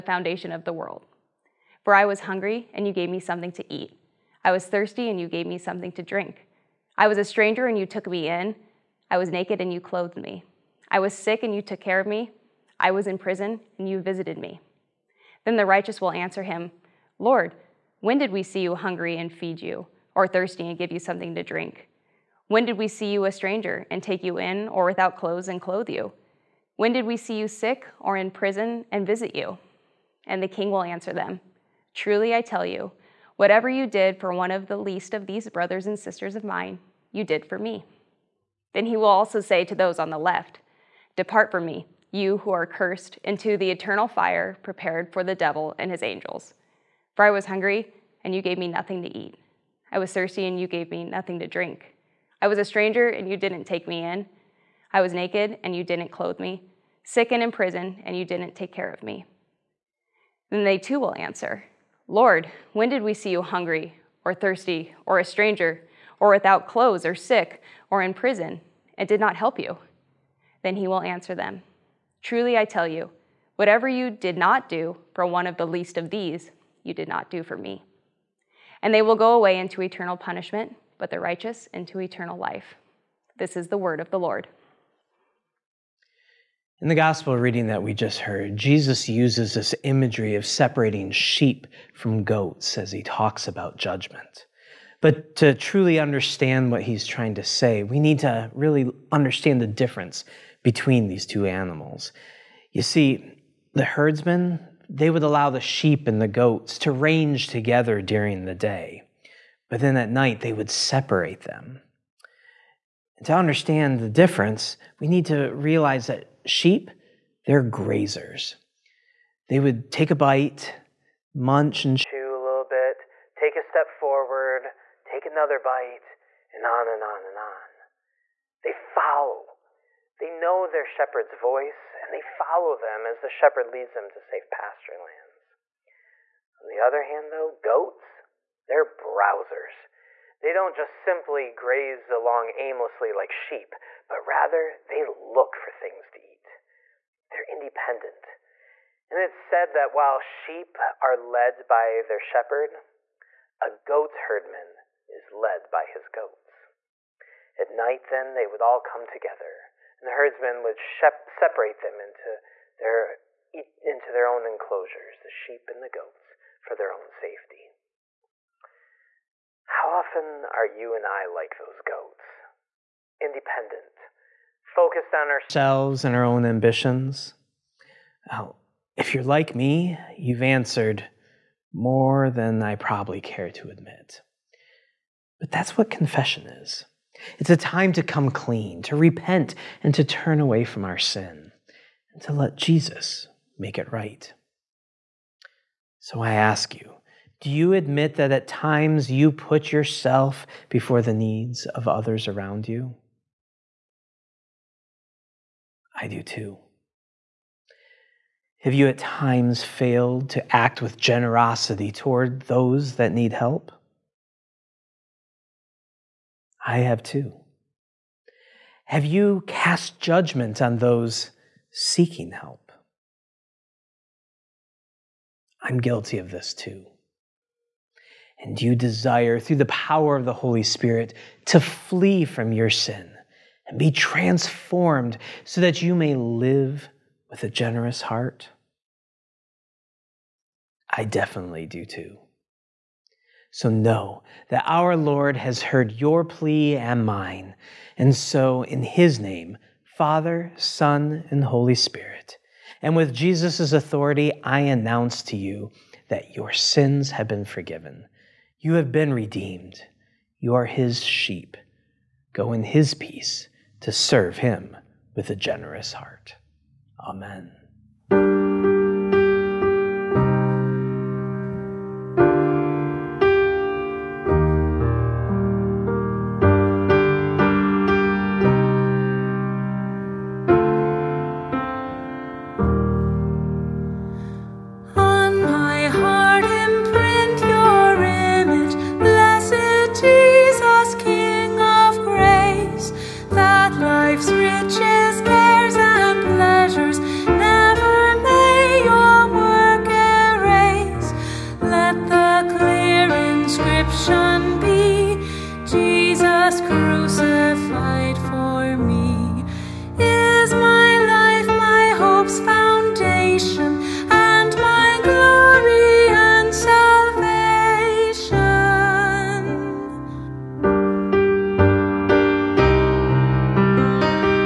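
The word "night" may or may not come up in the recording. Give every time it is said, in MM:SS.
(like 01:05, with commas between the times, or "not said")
01:50, 02:37.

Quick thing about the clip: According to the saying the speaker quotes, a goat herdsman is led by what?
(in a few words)
his goats.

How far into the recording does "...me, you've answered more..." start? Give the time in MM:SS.
02:59.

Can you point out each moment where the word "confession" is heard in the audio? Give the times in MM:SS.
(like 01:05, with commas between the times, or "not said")
03:05.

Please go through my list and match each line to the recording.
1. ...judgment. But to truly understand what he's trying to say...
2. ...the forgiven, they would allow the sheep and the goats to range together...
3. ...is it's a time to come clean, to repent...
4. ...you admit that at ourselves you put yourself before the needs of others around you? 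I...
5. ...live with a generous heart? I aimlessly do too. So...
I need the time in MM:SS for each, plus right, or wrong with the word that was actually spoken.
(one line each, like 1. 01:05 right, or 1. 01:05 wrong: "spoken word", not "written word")
1. 01:33 right
2. 01:43 wrong: "herdsmen", not "forgiven"
3. 03:06 right
4. 03:17 wrong: "times", not "ourselves"
5. 03:56 wrong: "definitely", not "aimlessly".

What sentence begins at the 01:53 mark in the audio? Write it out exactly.
And to understand the difference, we need to realize that sheep, they're grazers.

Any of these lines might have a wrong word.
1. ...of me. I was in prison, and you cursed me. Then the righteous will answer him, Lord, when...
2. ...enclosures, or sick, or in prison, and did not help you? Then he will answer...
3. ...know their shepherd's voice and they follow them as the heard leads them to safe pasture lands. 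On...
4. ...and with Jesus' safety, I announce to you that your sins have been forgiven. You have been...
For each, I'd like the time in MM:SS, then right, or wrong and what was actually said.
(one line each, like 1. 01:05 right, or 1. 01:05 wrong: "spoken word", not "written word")
1. 00:11 wrong: "visited", not "cursed"
2. 01:06 wrong: "clothes", not "enclosures"
3. 02:10 wrong: "shepherd", not "heard"
4. 04:12 wrong: "authority", not "safety".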